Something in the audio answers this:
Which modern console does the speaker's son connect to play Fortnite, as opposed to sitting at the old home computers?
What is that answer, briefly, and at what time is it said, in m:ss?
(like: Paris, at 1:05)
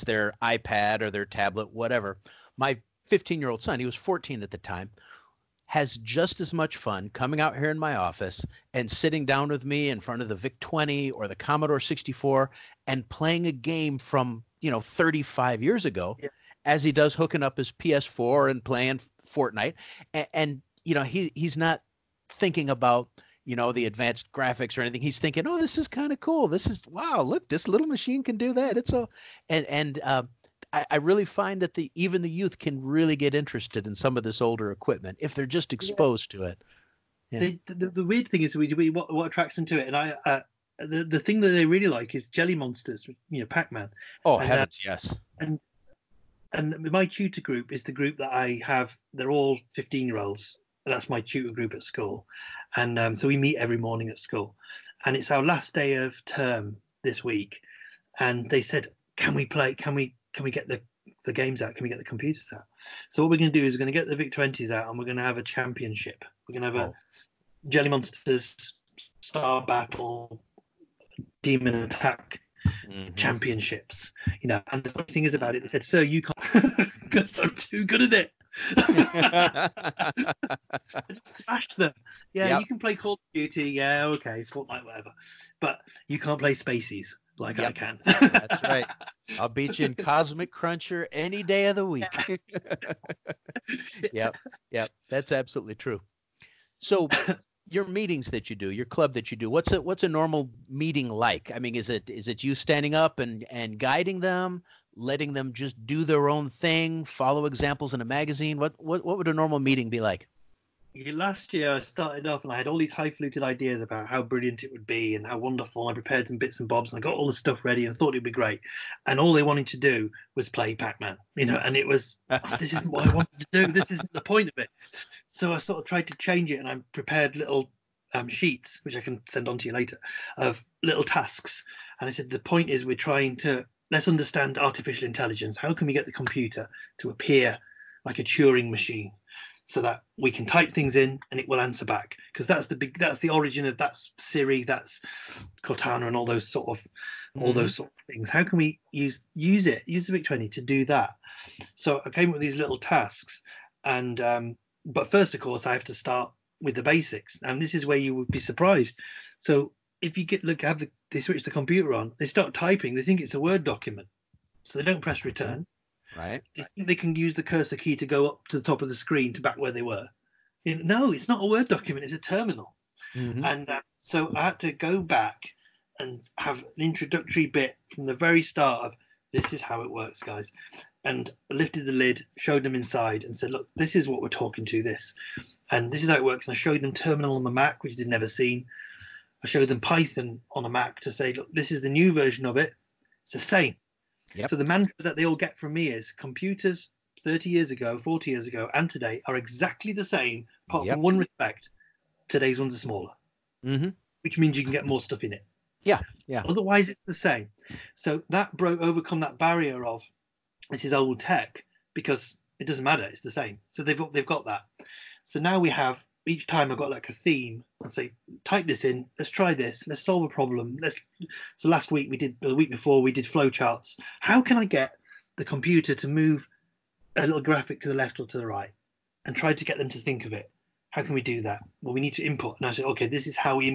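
PS4, at 0:17.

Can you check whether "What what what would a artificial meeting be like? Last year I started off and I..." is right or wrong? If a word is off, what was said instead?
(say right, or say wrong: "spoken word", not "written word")
wrong: "normal", not "artificial".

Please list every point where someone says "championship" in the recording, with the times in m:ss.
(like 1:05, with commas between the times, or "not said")
1:05, 1:13.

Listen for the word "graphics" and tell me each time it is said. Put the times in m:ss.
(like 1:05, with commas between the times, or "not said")
0:24, 3:47.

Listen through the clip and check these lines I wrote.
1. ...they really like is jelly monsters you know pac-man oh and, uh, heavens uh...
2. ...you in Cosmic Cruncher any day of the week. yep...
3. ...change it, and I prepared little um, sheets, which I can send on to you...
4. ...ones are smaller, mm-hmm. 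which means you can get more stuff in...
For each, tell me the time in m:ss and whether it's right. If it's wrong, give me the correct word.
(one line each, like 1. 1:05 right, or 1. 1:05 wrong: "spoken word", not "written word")
1. 0:41 right
2. 1:29 right
3. 2:06 right
4. 3:22 right.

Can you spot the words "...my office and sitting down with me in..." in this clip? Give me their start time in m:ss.
0:07.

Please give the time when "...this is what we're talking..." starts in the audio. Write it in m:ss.
3:03.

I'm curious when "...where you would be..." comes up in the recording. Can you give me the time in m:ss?
2:37.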